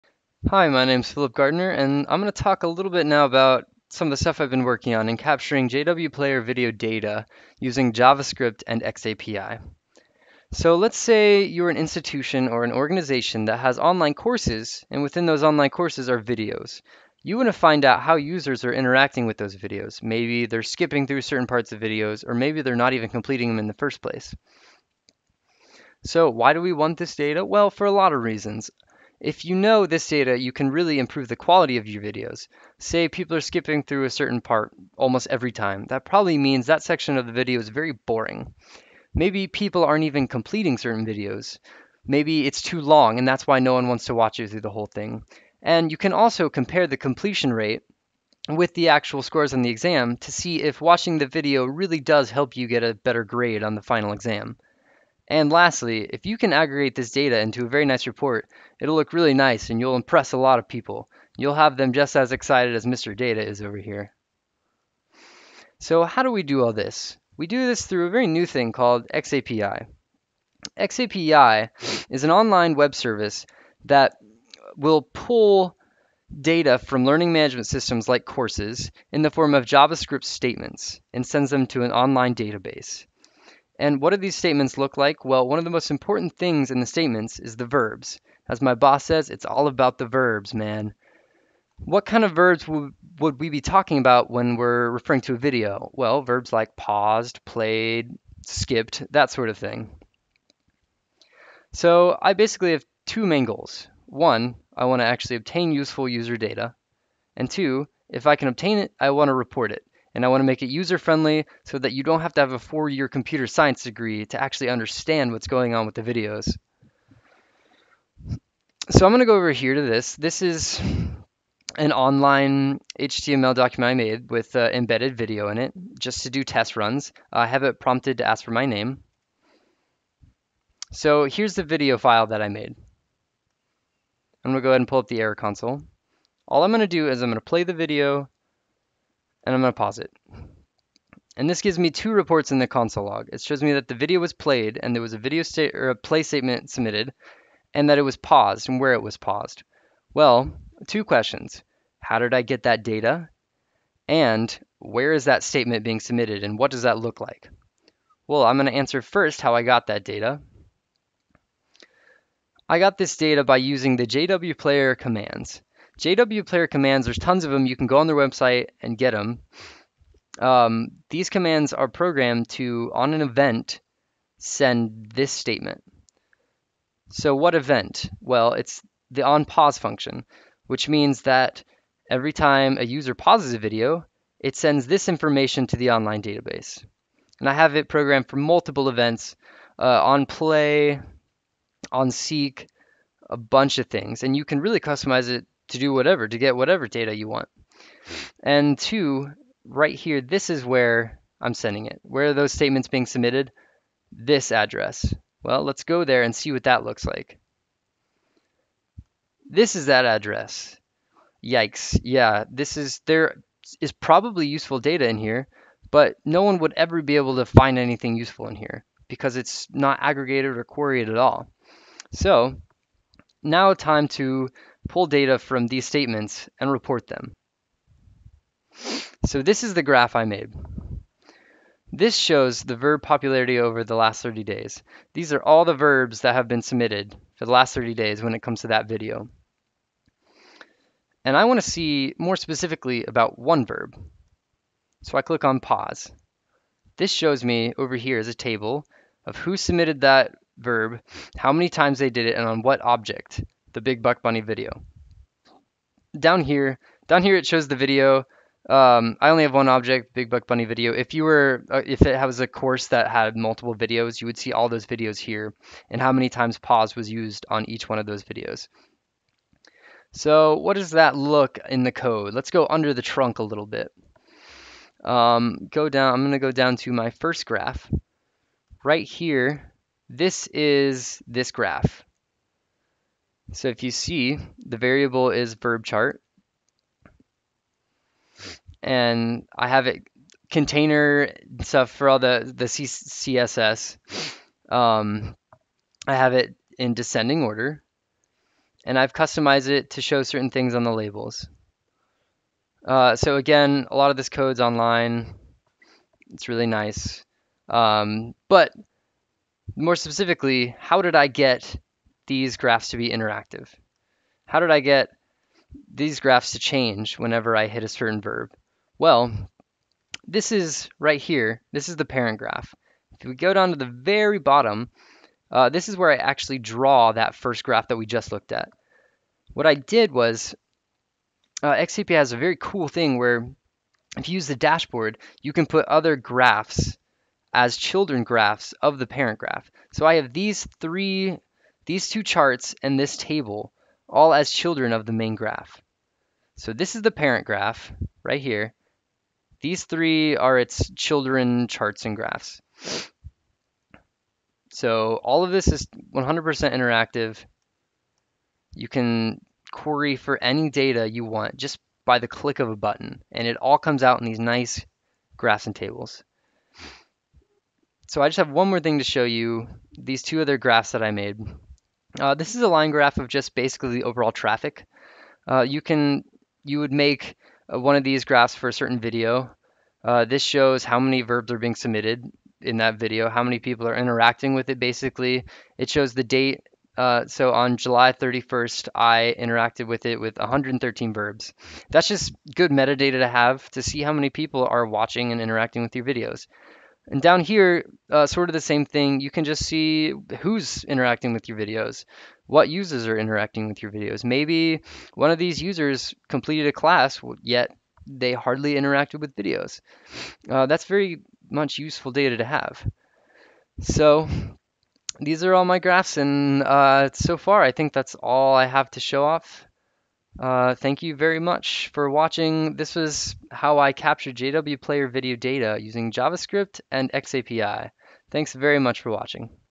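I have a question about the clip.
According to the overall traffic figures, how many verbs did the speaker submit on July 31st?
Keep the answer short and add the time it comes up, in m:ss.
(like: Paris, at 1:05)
113, at 6:30.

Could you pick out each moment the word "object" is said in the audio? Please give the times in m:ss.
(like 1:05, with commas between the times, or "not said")
4:12, 4:19.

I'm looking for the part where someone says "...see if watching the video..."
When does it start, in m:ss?
0:50.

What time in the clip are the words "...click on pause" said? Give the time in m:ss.
4:05.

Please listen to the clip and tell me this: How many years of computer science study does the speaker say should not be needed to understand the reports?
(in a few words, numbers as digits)
4.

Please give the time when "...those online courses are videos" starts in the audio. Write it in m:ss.
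0:15.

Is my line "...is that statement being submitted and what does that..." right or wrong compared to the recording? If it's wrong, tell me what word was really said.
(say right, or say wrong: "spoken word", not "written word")
right.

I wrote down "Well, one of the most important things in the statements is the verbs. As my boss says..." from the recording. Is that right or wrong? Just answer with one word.
right.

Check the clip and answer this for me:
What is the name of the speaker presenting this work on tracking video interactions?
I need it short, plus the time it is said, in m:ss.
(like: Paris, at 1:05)
Philip Gardner, at 0:01.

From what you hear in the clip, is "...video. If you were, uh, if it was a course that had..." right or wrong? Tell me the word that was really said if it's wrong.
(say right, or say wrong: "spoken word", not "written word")
right.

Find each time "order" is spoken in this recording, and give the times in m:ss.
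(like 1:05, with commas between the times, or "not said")
4:57.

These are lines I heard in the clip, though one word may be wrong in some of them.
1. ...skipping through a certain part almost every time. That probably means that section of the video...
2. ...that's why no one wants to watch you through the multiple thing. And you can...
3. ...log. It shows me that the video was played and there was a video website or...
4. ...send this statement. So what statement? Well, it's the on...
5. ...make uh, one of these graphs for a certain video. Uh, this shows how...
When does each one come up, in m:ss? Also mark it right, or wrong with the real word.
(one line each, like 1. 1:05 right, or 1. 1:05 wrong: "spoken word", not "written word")
1. 0:33 right
2. 0:43 wrong: "whole", not "multiple"
3. 2:23 wrong: "state", not "website"
4. 2:54 wrong: "event", not "statement"
5. 6:16 right.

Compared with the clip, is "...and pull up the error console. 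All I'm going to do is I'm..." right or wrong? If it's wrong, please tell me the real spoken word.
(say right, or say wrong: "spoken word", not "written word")
right.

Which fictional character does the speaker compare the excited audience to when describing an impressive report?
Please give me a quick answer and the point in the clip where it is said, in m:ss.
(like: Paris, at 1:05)
Mr. Data, at 1:02.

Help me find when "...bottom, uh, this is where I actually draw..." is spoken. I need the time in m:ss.
5:24.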